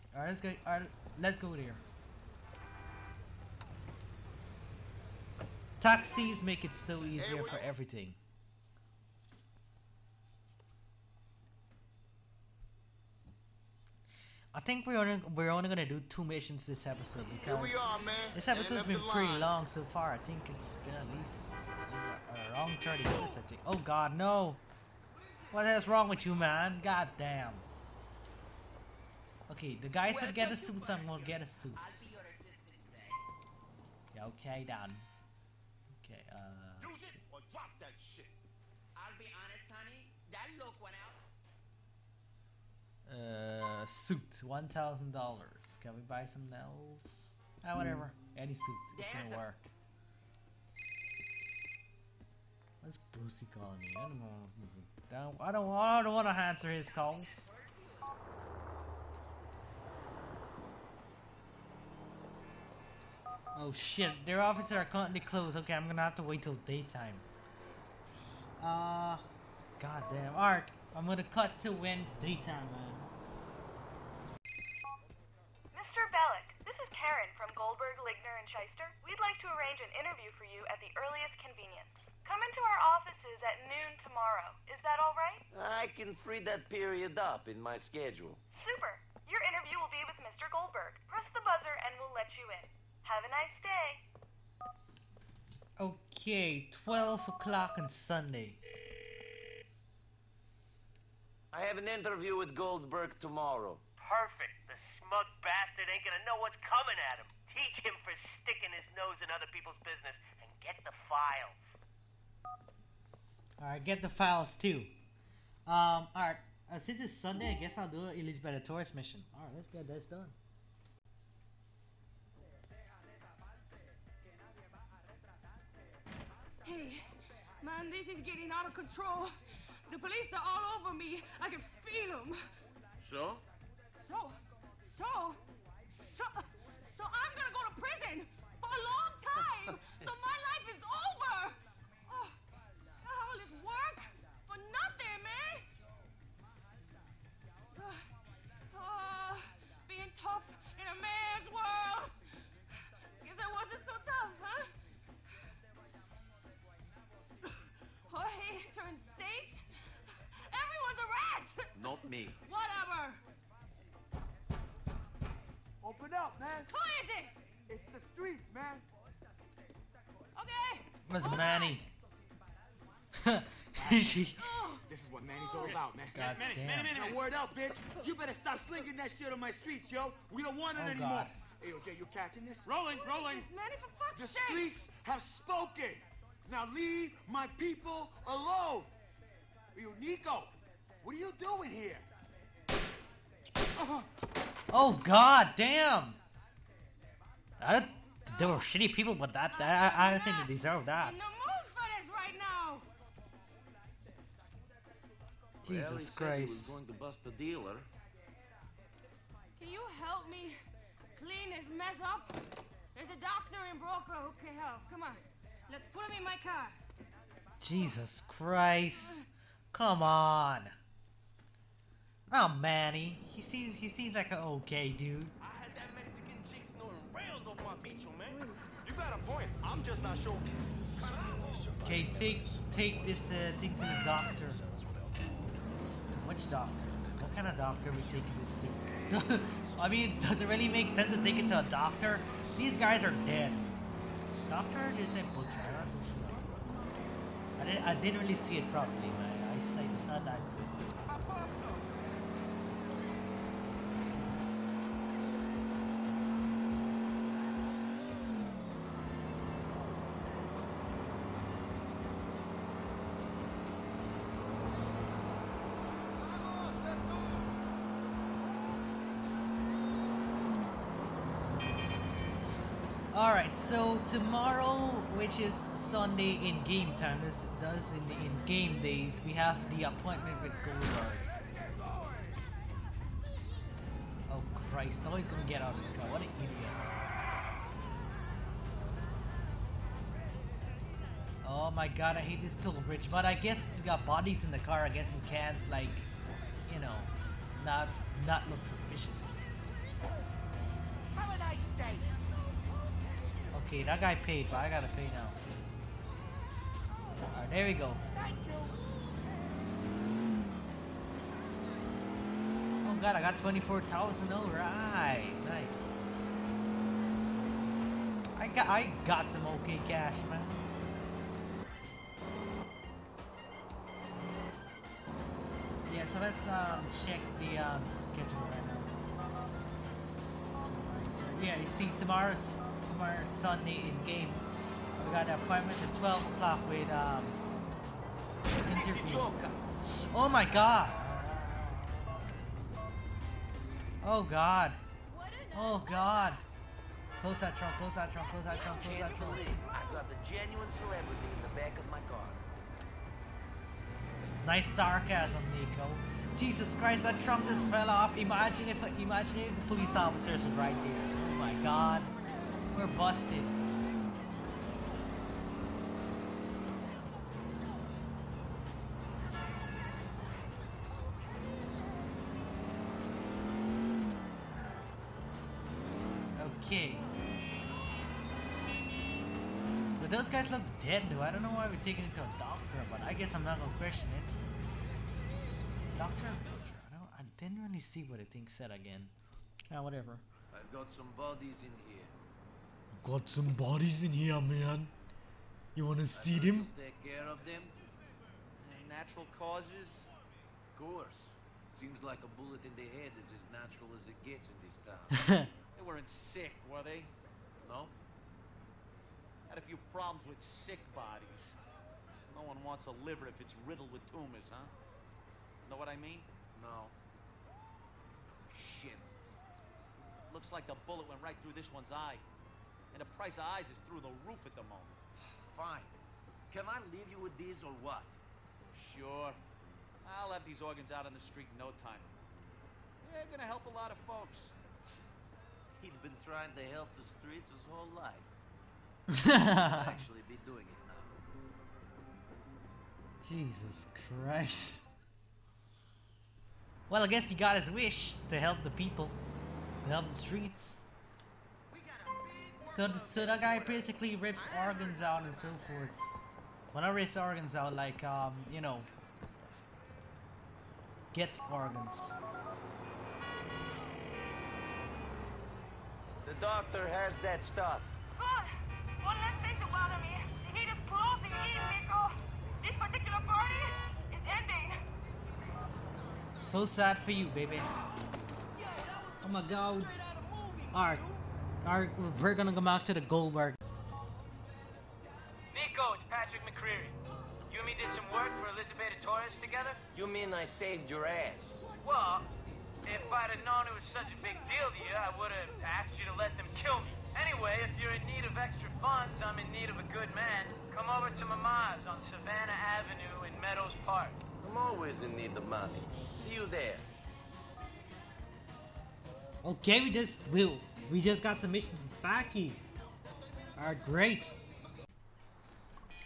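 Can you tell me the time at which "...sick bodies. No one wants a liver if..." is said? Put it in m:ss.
6:50.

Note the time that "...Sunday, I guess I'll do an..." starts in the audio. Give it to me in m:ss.
1:57.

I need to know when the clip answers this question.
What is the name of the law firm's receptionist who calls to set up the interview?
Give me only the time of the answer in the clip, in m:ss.
1:16.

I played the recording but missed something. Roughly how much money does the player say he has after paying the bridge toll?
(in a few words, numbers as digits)
24,000.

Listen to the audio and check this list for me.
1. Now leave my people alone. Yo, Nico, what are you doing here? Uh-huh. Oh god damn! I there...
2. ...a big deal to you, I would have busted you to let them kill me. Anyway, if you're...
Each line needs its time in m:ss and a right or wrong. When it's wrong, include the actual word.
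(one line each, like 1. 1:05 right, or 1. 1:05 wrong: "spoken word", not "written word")
1. 3:06 right
2. 8:14 wrong: "asked", not "busted".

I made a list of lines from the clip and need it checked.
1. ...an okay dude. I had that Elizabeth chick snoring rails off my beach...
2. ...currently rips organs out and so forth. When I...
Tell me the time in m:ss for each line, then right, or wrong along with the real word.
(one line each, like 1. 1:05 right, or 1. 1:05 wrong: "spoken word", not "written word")
1. 3:44 wrong: "Mexican", not "Elizabeth"
2. 7:33 wrong: "basically", not "currently".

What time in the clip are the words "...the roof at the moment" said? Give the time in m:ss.
7:03.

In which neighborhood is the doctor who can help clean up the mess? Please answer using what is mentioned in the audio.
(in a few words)
Broker.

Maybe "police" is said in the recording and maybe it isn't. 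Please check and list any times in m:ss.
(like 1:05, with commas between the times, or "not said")
2:09, 5:59.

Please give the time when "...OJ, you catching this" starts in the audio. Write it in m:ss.
3:01.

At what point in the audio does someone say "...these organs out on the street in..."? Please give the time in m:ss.
7:10.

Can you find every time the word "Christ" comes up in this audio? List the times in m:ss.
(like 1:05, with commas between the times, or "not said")
3:26, 3:38, 4:44, 5:56, 7:24.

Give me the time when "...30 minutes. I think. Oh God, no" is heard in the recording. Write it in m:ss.
0:22.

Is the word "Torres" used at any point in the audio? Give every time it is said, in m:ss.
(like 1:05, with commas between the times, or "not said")
1:58, 8:09.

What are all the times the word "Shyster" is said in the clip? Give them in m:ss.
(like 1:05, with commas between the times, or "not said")
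1:18.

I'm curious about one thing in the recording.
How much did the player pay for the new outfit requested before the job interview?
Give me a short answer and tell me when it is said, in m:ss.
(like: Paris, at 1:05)
$1000, at 0:44.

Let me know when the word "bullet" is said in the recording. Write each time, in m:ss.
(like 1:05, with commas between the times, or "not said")
6:42, 7:00.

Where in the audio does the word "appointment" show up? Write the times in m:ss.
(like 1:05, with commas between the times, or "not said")
4:39, 5:35.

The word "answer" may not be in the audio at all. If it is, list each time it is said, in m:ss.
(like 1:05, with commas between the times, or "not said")
0:56.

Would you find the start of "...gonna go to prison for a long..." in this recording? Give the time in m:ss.
2:17.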